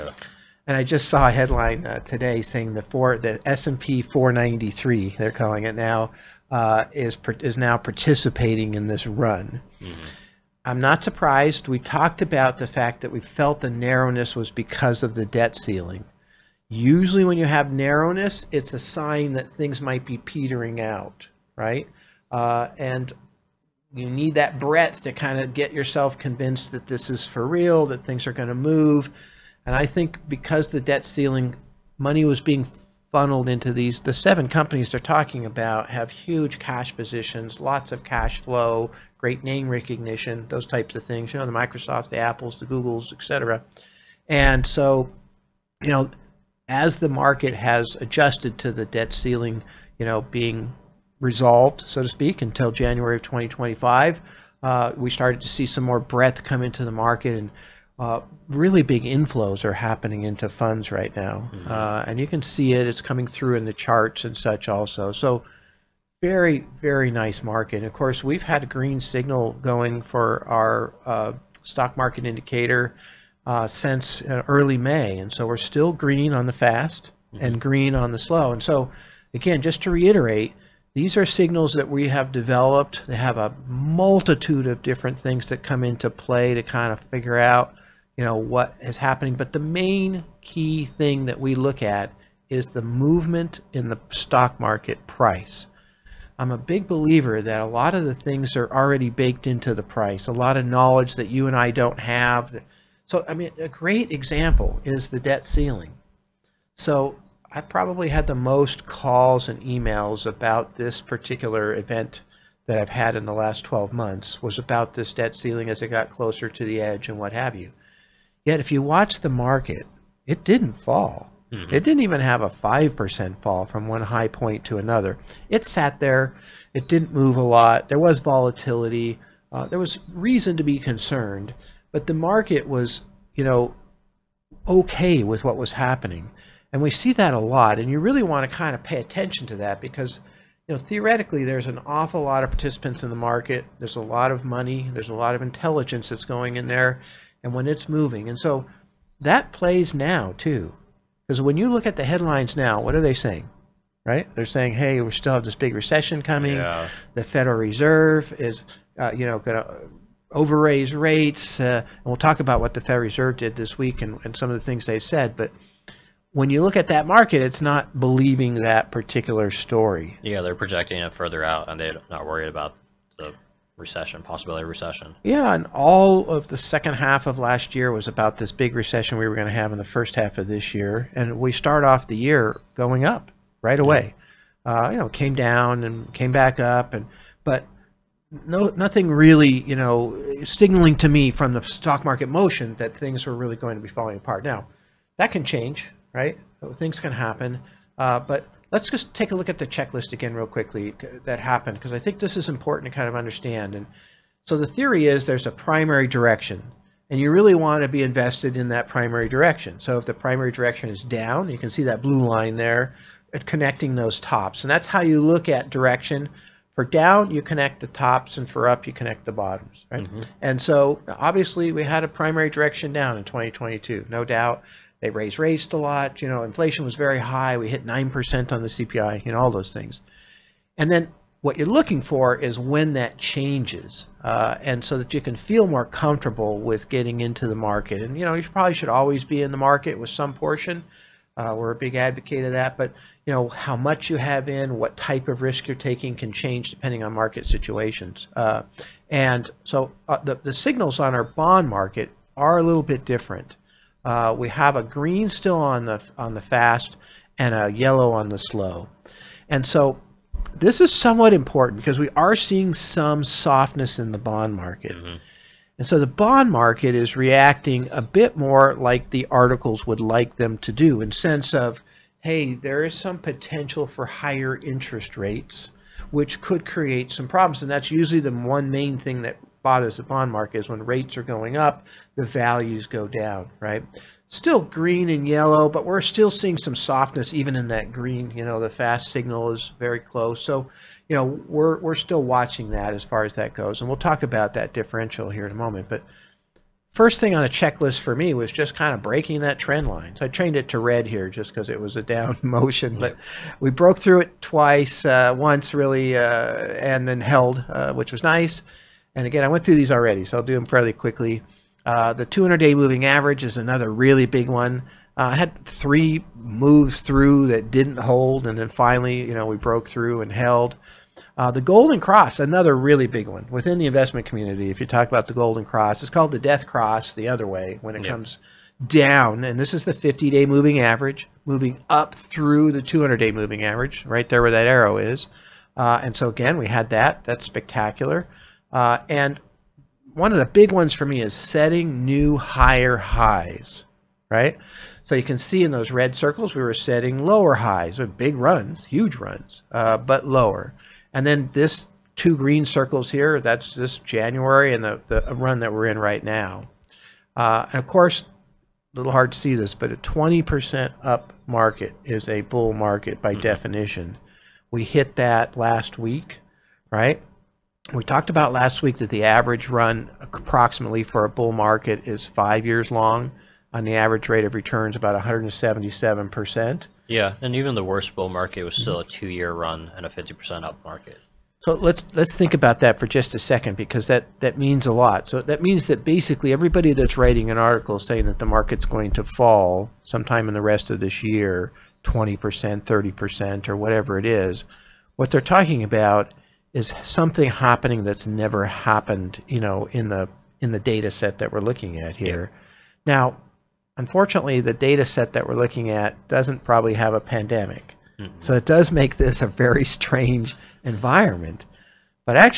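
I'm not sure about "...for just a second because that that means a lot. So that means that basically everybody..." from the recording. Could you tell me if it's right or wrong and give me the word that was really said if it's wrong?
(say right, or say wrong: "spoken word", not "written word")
right.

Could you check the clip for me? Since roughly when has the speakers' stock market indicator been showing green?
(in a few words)
early May.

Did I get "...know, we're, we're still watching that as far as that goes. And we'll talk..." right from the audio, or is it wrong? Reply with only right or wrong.
right.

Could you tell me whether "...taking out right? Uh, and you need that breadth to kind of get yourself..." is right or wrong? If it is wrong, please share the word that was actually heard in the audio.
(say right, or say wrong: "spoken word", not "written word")
wrong: "petering", not "taking".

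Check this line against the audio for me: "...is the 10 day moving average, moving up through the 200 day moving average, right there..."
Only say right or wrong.
wrong.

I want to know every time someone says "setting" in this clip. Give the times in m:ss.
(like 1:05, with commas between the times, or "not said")
5:41, 5:46.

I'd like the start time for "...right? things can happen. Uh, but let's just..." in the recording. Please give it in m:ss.
3:16.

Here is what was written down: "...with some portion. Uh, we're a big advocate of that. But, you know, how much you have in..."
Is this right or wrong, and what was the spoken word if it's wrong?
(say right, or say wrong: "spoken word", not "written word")
right.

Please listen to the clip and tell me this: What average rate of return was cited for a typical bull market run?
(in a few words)
177%.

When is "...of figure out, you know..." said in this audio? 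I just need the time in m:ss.
1:26.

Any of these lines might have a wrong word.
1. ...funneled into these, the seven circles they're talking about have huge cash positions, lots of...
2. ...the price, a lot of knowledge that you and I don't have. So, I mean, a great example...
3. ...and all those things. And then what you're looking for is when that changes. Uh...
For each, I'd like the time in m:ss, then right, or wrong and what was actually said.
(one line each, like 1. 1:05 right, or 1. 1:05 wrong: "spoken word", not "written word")
1. 0:33 wrong: "companies", not "circles"
2. 1:39 right
3. 3:49 right.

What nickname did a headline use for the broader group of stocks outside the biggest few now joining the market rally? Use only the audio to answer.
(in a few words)
S&P 493.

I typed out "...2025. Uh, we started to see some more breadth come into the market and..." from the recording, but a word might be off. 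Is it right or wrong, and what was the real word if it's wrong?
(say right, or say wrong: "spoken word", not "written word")
right.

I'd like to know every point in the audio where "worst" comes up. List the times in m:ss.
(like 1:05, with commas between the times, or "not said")
6:17.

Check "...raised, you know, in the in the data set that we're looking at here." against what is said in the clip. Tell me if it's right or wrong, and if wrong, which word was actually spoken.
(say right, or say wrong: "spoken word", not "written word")
wrong: "happened", not "raised".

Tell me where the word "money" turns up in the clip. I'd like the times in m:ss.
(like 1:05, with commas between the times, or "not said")
0:31, 2:24.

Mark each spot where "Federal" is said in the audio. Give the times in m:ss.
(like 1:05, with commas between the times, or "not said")
2:37, 2:42.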